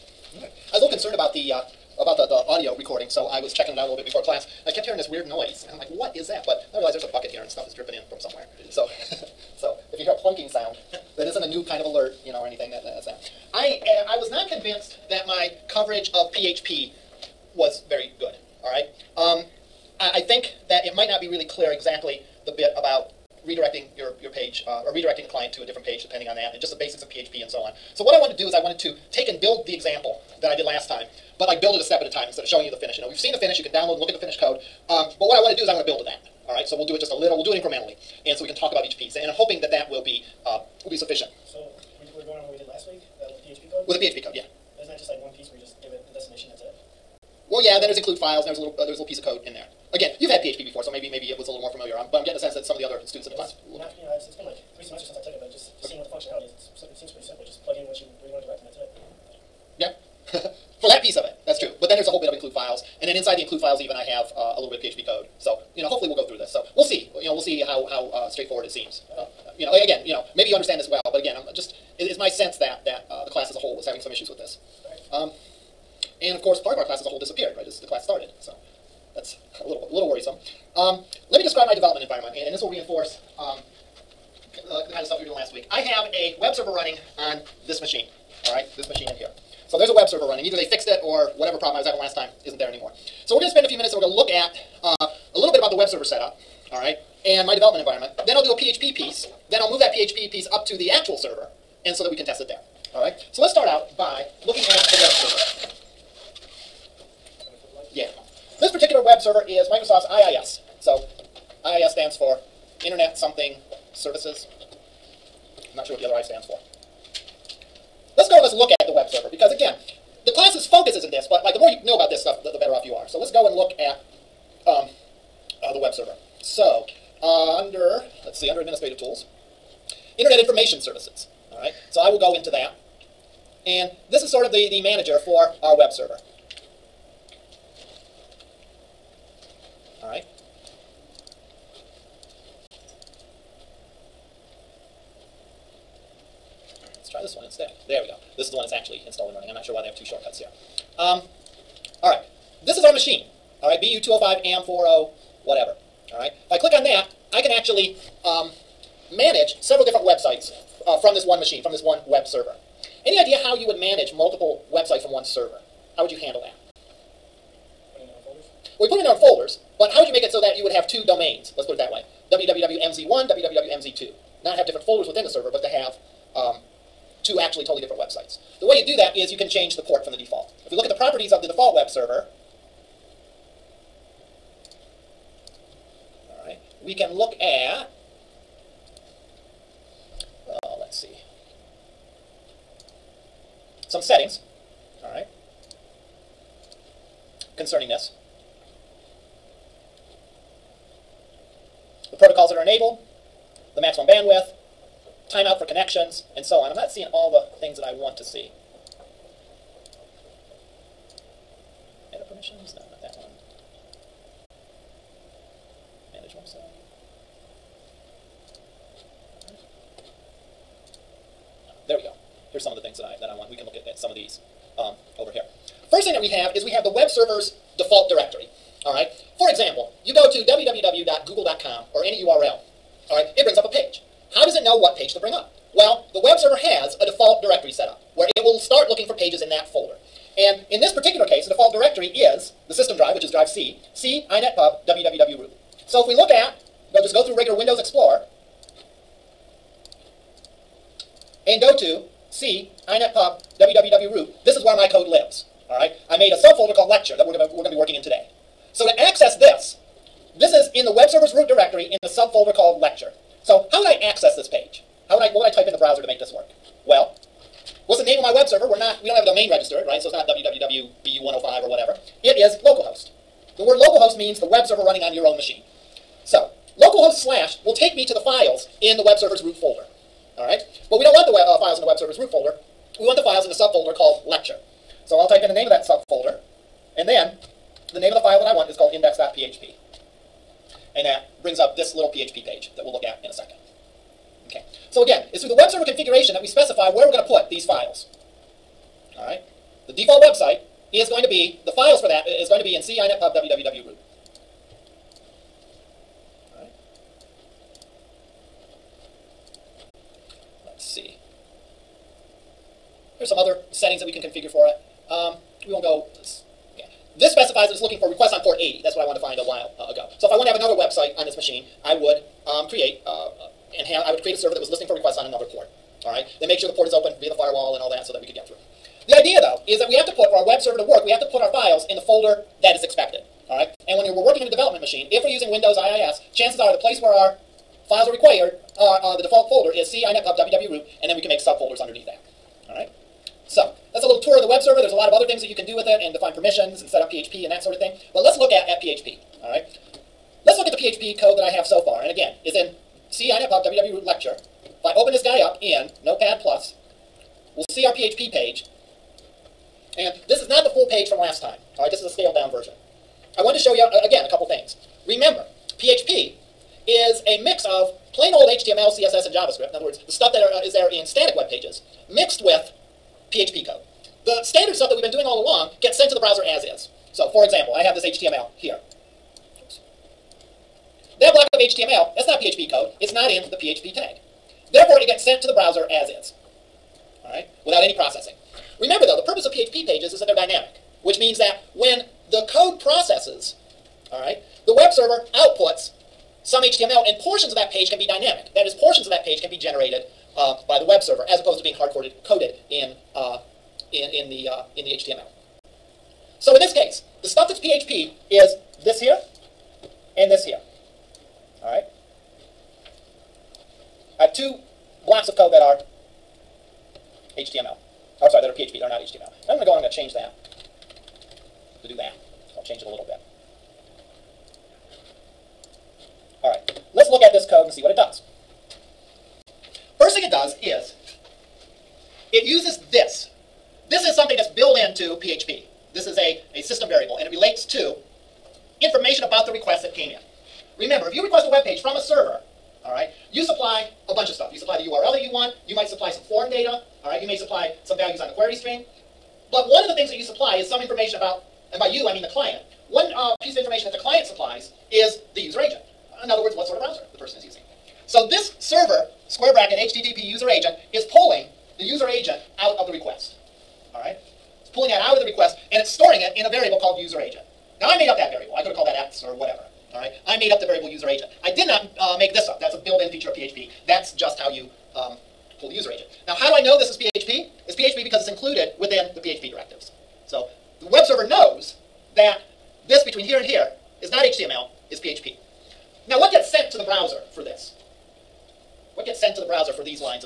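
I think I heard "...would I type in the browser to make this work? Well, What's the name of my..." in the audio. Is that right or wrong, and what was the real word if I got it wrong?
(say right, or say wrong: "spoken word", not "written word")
right.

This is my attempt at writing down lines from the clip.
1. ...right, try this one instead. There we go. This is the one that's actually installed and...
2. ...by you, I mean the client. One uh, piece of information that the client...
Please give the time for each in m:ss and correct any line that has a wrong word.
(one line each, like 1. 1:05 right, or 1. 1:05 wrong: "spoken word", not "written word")
1. 2:20 right
2. 7:31 right.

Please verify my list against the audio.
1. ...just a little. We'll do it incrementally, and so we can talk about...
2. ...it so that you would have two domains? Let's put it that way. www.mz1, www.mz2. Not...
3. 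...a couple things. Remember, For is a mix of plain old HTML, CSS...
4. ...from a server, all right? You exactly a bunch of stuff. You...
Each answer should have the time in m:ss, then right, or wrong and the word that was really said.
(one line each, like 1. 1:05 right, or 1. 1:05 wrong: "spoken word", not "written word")
1. 0:36 right
2. 2:50 right
3. 6:04 wrong: "PHP", not "For"
4. 7:21 wrong: "supply", not "exactly".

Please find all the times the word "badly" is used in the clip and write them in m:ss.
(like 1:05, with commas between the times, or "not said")
not said.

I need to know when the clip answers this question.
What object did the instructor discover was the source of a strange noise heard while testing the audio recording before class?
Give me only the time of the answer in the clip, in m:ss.
0:07.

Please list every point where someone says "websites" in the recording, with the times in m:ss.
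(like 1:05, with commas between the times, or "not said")
2:40, 2:44, 2:57, 5:00, 5:20.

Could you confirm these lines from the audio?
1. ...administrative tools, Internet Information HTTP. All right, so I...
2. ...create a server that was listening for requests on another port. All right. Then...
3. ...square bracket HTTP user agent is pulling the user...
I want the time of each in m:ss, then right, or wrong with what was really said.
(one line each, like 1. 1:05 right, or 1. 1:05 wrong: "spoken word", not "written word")
1. 2:08 wrong: "Services", not "HTTP"
2. 5:24 right
3. 7:39 right.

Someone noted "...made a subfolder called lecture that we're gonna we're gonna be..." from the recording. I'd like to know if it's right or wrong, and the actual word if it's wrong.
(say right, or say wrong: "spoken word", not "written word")
right.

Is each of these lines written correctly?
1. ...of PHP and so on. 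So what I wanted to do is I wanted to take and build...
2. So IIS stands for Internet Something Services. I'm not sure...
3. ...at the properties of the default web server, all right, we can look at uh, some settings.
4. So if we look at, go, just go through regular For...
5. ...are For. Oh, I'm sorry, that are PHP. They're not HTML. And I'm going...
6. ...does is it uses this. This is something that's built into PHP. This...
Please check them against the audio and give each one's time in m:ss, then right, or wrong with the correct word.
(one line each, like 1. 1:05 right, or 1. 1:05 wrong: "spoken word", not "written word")
1. 0:27 right
2. 1:50 right
3. 3:00 right
4. 4:05 wrong: "Windows", not "For"
5. 6:55 wrong: "HTML", not "For"
6. 7:10 right.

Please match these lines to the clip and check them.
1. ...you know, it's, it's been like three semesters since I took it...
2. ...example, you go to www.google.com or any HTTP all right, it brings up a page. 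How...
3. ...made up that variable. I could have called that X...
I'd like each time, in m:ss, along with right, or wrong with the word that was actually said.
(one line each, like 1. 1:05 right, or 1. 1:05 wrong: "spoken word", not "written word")
1. 0:53 right
2. 3:49 wrong: "URL", not "HTTP"
3. 7:47 right.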